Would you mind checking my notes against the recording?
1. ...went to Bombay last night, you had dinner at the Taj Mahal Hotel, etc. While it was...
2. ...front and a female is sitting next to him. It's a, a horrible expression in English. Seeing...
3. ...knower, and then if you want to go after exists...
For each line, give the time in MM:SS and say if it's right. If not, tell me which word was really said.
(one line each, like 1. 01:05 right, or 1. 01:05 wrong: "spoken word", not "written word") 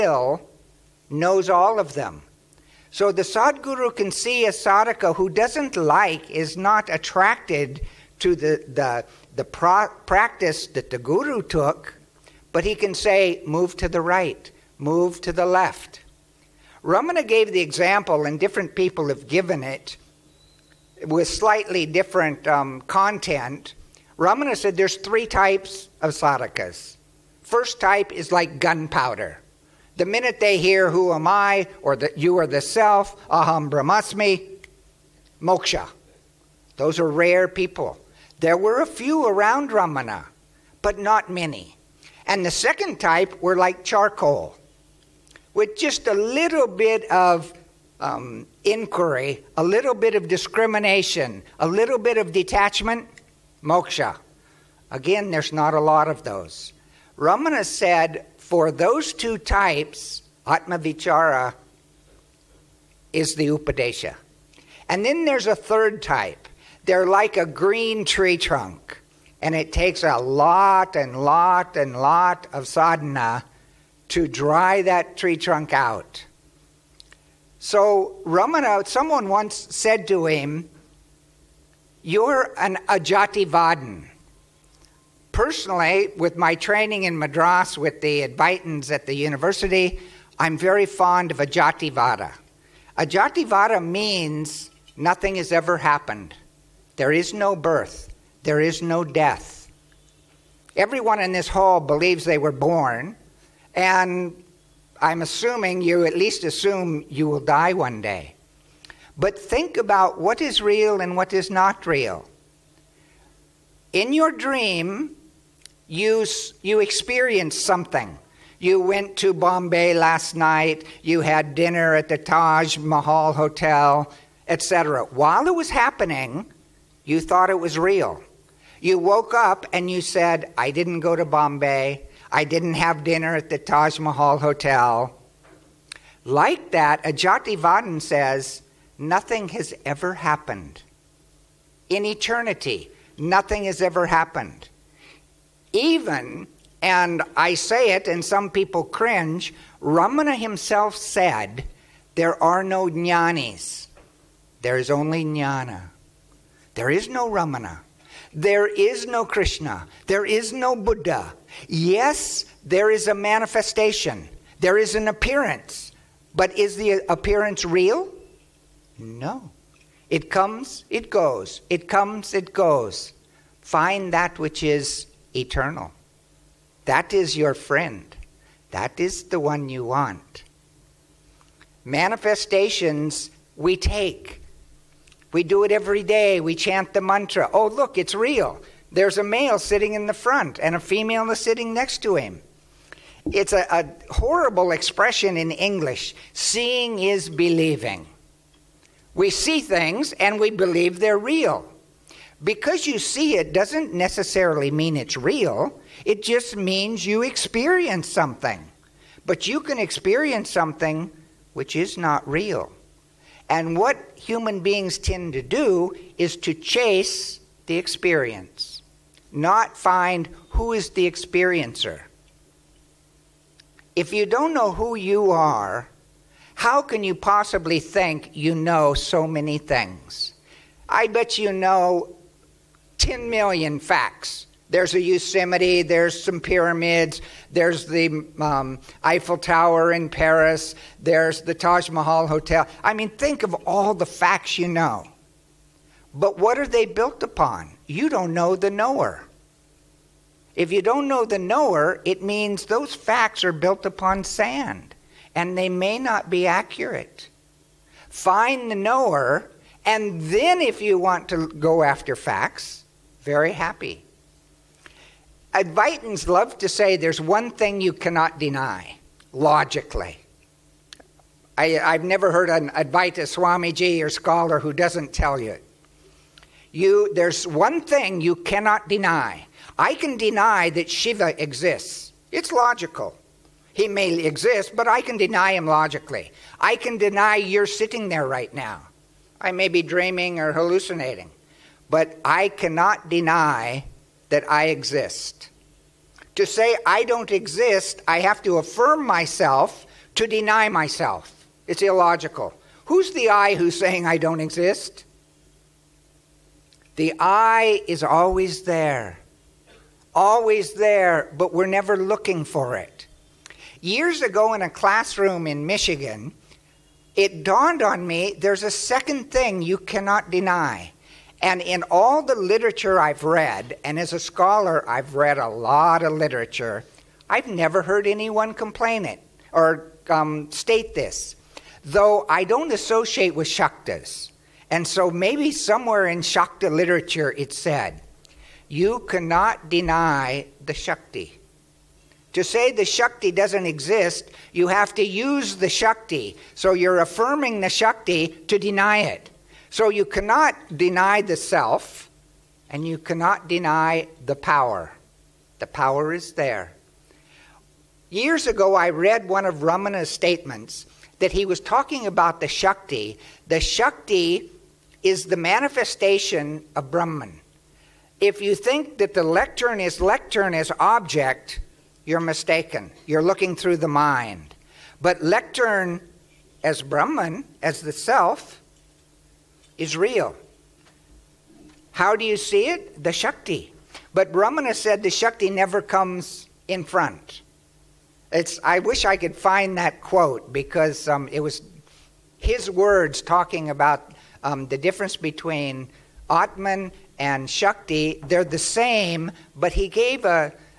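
1. 01:58 right
2. 03:10 right
3. 04:18 wrong: "facts", not "exists".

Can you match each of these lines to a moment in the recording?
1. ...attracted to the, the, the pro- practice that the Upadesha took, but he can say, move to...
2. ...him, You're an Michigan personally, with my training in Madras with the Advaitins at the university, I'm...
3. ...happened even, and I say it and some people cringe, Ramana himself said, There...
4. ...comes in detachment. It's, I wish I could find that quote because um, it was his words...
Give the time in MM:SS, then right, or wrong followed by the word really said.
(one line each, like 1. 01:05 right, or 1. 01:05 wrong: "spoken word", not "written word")
1. 00:06 wrong: "Guru", not "Upadesha"
2. 01:20 wrong: "Ajativadin", not "Michigan"
3. 02:24 right
4. 06:25 wrong: "front", not "detachment".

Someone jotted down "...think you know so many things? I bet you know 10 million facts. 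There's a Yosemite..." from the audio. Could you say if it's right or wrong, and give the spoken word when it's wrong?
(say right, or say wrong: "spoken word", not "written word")
right.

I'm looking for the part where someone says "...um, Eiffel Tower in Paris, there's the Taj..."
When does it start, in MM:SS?
03:58.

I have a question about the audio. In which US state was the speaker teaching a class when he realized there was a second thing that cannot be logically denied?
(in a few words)
Michigan.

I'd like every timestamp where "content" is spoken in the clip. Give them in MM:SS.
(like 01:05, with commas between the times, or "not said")
00:22.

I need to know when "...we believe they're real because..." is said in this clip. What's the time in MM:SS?
03:20.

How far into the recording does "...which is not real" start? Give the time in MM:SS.
03:31.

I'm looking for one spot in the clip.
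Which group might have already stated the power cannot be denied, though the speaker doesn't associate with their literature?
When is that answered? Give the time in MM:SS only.
05:33.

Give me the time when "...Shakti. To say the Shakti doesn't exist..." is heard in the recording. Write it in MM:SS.
05:40.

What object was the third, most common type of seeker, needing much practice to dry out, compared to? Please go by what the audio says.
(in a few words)
A green tree trunk.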